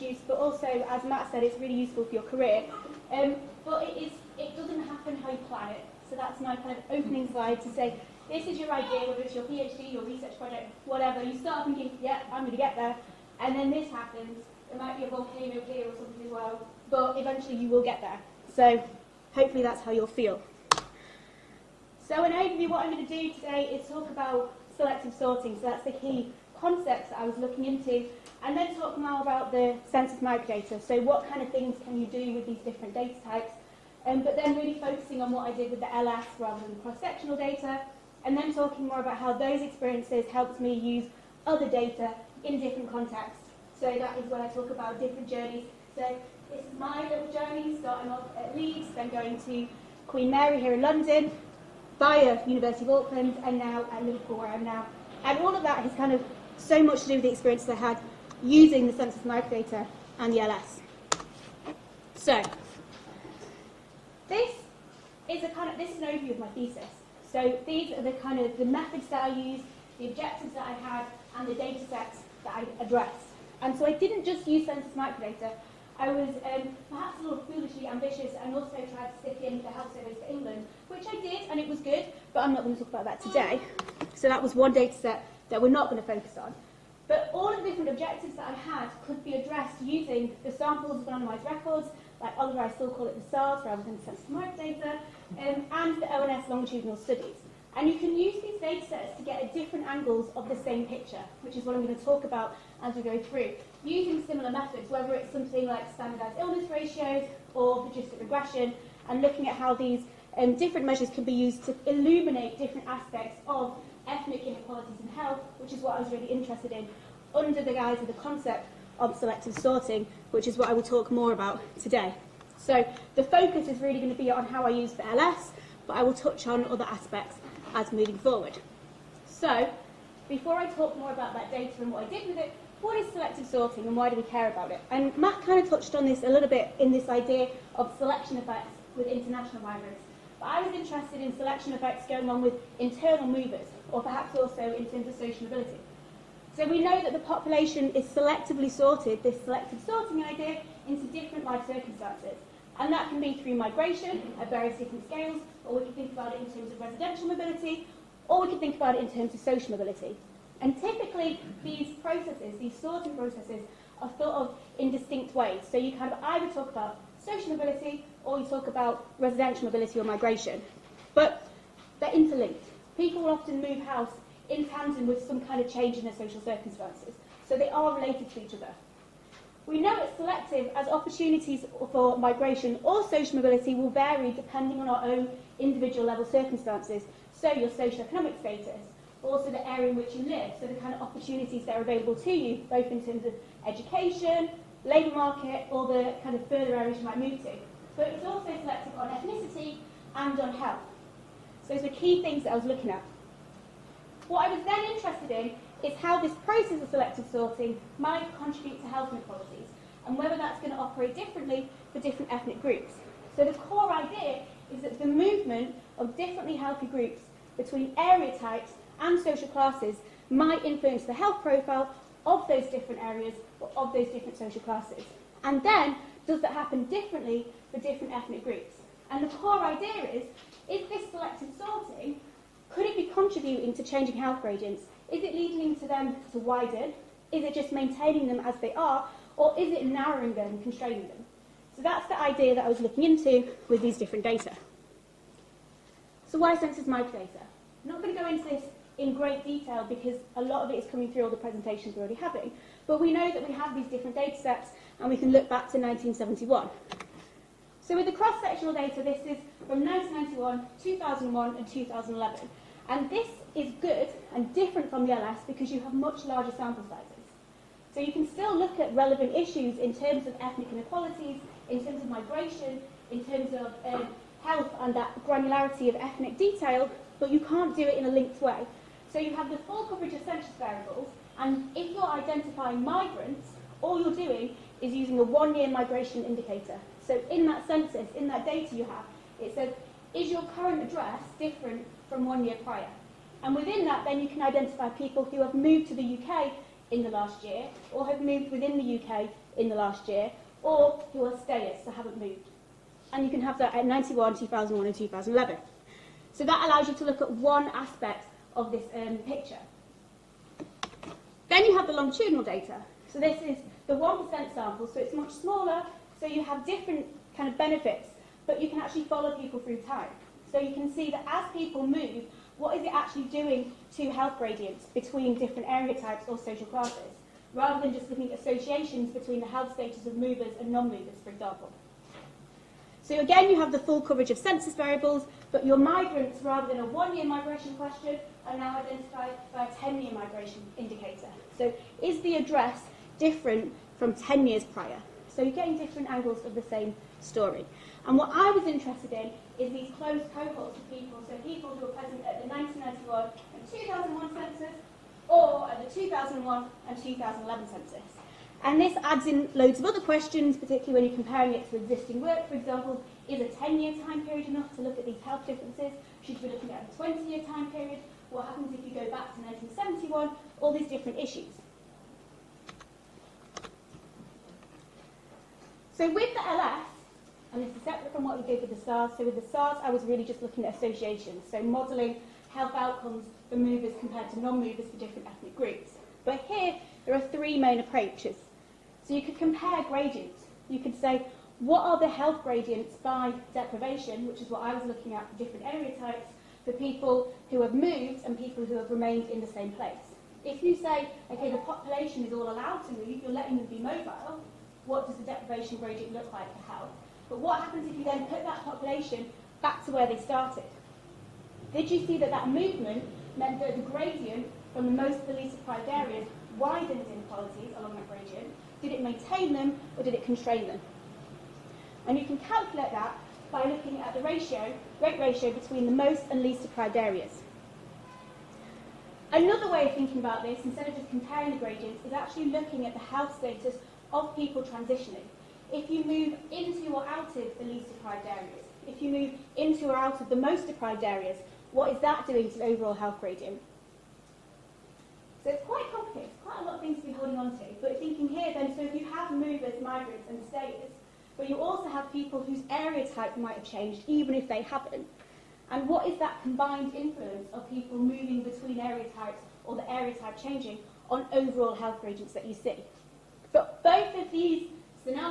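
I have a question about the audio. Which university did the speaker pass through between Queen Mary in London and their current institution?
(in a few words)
University of Auckland.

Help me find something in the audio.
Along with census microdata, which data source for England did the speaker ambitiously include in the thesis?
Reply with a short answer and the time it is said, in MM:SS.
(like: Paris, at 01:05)
health service, at 01:19.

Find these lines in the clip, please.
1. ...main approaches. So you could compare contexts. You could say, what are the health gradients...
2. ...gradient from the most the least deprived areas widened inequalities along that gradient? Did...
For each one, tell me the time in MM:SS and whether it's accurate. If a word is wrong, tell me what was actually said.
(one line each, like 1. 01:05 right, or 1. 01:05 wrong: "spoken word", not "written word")
1. 06:27 wrong: "gradients", not "contexts"
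2. 06:53 right.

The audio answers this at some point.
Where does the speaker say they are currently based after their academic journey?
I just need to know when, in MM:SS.
00:54.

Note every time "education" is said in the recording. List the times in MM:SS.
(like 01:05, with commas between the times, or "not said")
03:13.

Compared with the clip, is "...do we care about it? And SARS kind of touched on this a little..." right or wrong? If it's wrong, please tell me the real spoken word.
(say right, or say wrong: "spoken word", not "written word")
wrong: "Matt", not "SARS".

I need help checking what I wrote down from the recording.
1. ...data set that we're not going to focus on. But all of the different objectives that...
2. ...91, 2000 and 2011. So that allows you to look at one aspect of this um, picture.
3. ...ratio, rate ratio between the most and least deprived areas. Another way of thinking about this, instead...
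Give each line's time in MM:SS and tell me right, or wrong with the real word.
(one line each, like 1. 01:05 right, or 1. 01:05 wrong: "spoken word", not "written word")
1. 01:24 right
2. 05:03 wrong: "2001", not "2000"
3. 07:04 right.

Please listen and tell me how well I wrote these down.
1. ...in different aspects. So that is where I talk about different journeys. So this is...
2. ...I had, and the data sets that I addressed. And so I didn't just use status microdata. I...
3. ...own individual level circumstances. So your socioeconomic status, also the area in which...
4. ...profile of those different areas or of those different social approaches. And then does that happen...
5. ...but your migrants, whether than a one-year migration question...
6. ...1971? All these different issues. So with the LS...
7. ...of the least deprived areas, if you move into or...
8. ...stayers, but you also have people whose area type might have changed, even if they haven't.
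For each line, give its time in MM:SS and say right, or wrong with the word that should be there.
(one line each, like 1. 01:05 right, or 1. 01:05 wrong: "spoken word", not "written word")
1. 00:42 wrong: "contexts", not "aspects"
2. 01:10 wrong: "census", not "status"
3. 03:05 right
4. 03:41 wrong: "classes", not "approaches"
5. 05:35 wrong: "rather", not "whether"
6. 06:09 right
7. 07:17 right
8. 07:30 right.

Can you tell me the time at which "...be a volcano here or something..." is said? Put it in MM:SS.
00:14.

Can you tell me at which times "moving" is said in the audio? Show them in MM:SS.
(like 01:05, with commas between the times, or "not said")
02:07, 07:37.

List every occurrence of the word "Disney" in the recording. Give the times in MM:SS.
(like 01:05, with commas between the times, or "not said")
not said.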